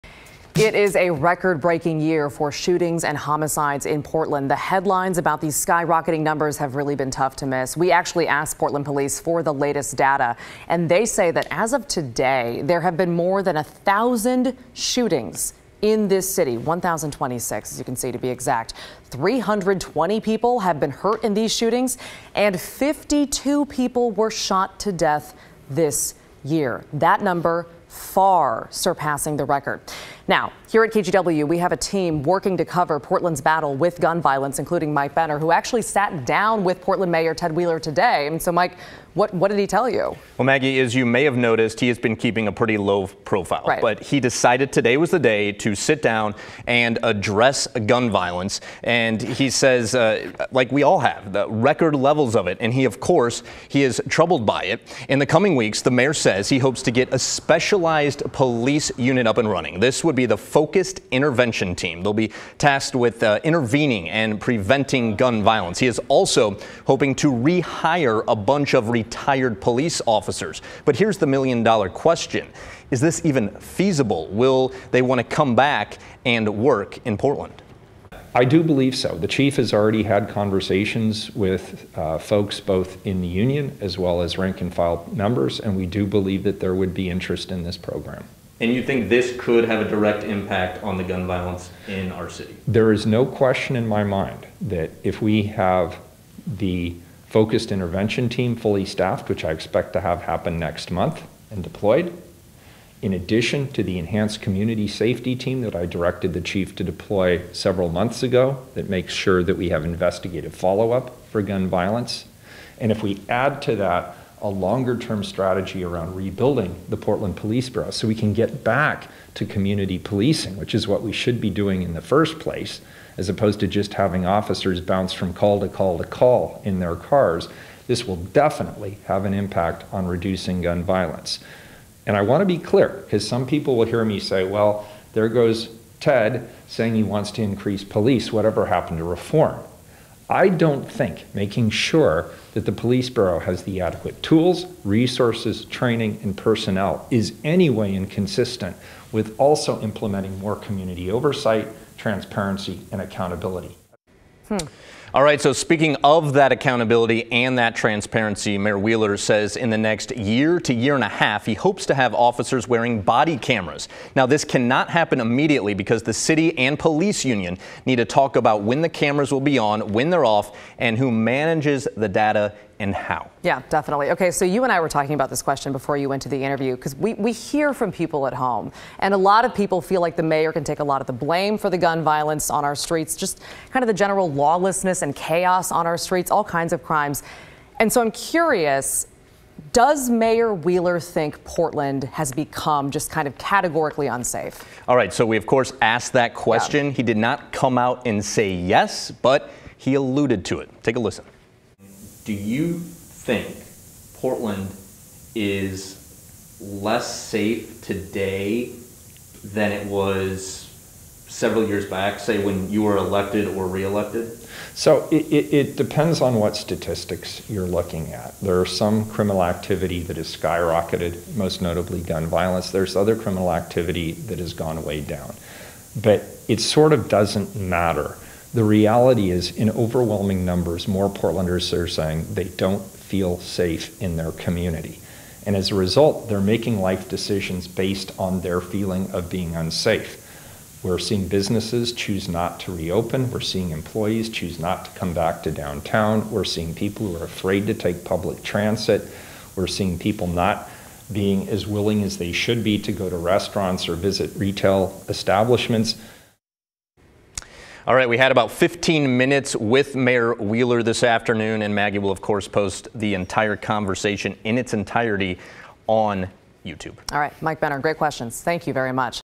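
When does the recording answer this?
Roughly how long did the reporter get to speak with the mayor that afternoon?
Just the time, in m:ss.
4:18.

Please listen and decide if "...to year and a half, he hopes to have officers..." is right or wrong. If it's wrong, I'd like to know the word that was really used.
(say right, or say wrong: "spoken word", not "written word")
right.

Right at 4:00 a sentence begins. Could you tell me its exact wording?
We're seeing businesses choose not to reopen.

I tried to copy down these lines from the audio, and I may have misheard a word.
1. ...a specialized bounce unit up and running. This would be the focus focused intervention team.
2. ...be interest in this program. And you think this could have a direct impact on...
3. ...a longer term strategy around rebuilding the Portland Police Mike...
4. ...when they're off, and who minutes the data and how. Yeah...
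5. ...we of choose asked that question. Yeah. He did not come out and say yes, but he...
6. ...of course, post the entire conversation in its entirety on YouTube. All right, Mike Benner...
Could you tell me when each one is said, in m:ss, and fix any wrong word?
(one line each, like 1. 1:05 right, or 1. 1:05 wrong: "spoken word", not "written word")
1. 0:57 wrong: "police", not "bounce"
2. 1:26 right
3. 1:54 wrong: "Bureau", not "Mike"
4. 2:49 wrong: "manages", not "minutes"
5. 3:15 wrong: "course", not "choose"
6. 4:22 right.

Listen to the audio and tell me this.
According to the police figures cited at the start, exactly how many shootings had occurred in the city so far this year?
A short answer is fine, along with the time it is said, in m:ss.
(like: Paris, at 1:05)
1,026, at 0:16.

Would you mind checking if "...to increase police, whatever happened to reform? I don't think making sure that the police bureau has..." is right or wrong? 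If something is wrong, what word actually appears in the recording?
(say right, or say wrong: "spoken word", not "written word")
right.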